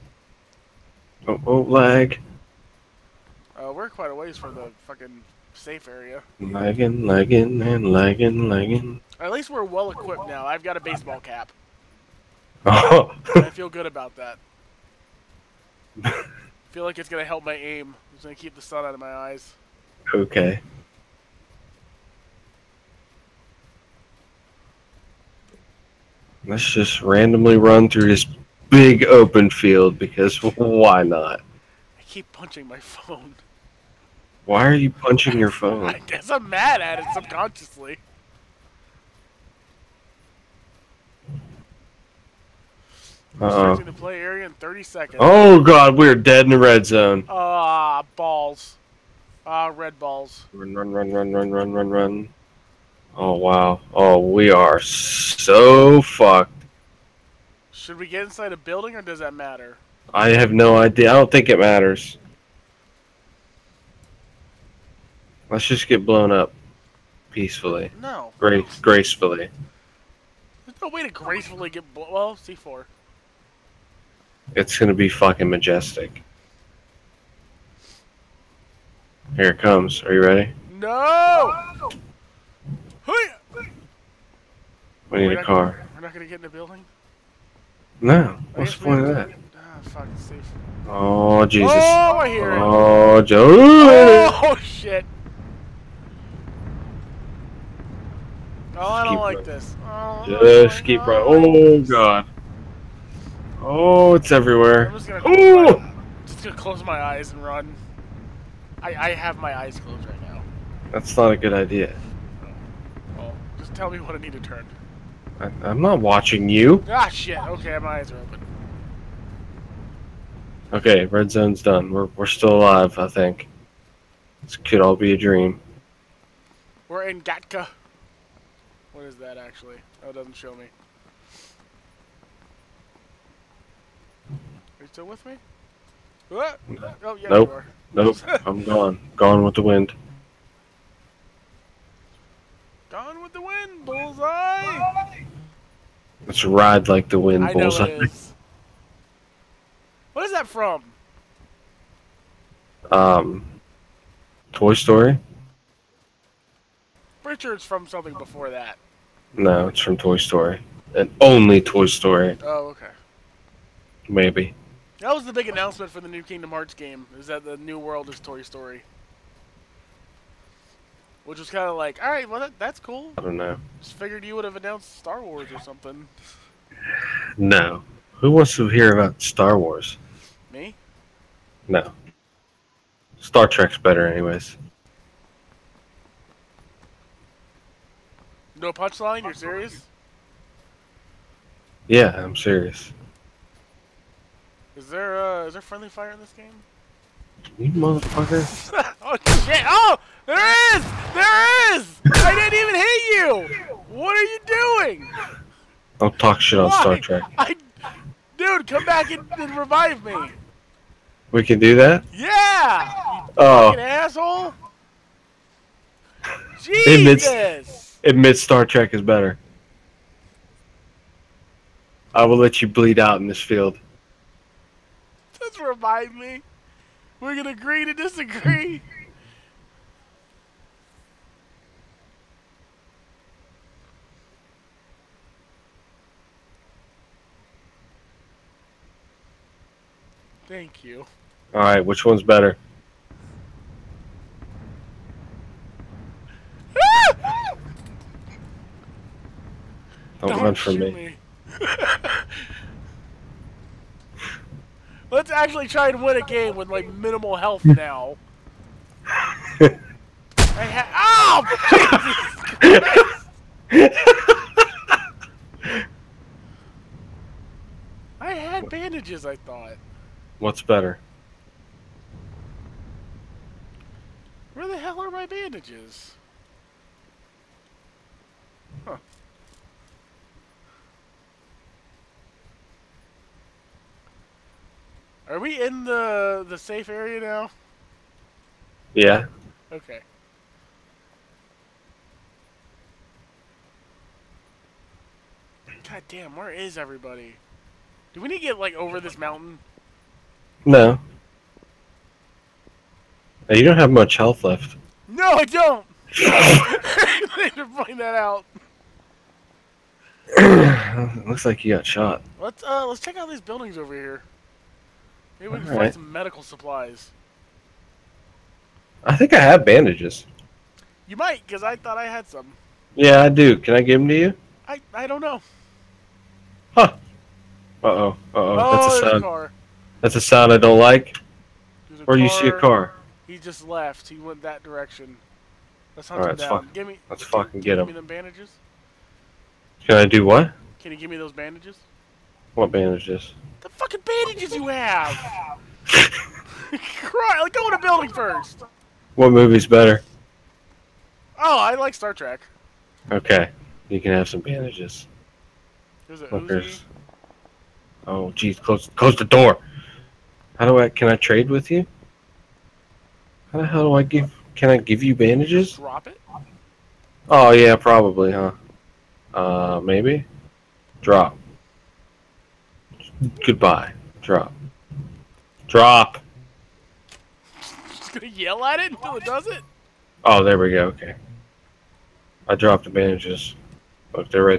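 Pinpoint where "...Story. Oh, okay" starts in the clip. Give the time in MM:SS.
02:41.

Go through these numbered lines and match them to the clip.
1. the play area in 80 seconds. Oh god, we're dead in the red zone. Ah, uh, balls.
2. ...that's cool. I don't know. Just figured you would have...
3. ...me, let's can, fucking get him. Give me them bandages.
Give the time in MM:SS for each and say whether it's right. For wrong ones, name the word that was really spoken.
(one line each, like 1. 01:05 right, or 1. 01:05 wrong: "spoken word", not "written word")
1. 00:43 wrong: "30", not "80"
2. 02:52 right
3. 05:36 right.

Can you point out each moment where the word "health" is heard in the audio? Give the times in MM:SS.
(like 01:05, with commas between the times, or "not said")
04:17, 05:04.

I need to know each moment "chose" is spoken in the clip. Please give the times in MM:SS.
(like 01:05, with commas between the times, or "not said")
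not said.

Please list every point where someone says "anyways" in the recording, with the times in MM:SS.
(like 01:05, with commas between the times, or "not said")
03:04.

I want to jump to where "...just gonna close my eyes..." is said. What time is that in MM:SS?
01:46.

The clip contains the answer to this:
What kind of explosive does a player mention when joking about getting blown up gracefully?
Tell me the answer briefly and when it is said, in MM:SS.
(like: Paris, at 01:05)
C4, at 01:12.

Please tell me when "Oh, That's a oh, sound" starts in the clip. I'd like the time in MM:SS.
05:28.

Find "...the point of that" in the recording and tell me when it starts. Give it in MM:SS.
01:28.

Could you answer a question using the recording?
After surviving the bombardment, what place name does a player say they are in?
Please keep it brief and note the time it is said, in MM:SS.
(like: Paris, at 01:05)
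Gatka, at 02:07.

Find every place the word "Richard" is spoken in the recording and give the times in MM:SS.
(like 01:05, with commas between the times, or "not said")
02:37.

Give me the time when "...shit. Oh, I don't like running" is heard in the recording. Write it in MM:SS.
01:34.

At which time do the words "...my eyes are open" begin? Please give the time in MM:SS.
01:57.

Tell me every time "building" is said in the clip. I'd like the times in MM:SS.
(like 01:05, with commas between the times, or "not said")
00:58, 01:26, 05:13, 05:47.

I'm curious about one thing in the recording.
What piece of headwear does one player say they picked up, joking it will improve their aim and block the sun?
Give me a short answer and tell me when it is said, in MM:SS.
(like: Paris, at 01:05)
baseball cap, at 00:10.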